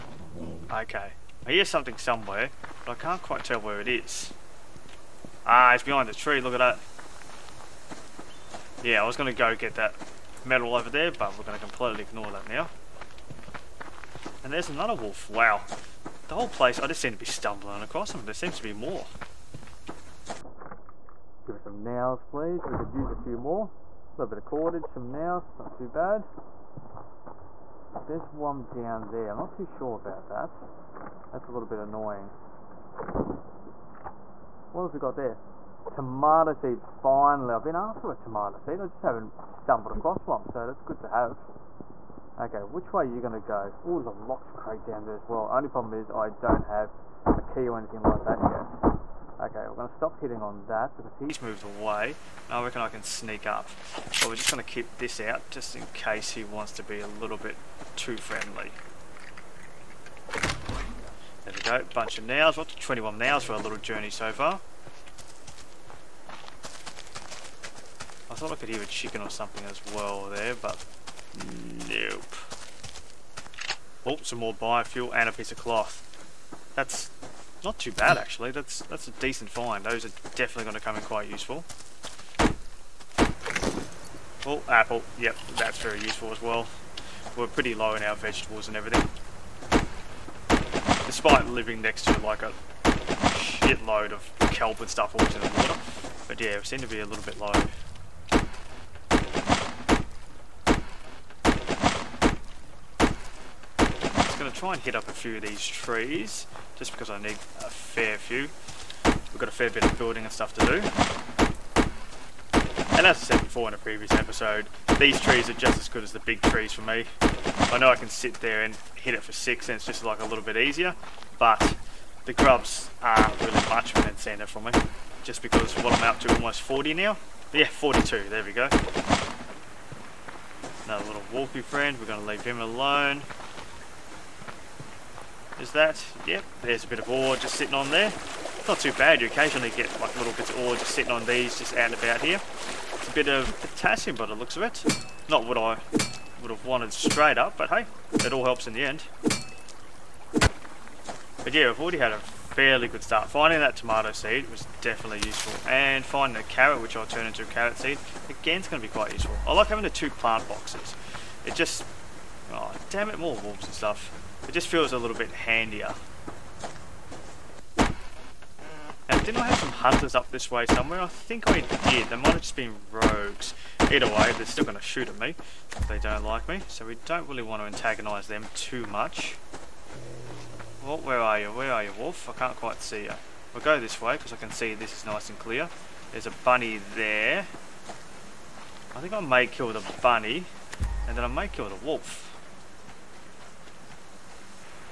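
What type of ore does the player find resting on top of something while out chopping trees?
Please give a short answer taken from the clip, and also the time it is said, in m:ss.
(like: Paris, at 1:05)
Potassium, at 2:23.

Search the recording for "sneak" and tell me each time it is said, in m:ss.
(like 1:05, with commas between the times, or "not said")
0:53.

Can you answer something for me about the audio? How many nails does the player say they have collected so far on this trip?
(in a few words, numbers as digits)
21.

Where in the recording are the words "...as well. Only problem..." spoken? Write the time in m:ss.
0:45.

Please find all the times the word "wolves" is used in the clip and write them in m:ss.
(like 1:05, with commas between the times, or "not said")
2:43.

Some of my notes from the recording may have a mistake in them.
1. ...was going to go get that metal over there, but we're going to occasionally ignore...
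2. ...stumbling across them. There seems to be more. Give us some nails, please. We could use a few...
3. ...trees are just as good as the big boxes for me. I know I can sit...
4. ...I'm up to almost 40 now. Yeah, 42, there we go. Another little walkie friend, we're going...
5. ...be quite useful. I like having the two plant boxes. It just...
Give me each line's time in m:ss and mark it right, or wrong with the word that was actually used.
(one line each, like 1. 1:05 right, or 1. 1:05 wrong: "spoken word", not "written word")
1. 0:09 wrong: "completely", not "occasionally"
2. 0:17 right
3. 1:55 wrong: "trees", not "boxes"
4. 2:05 right
5. 2:38 right.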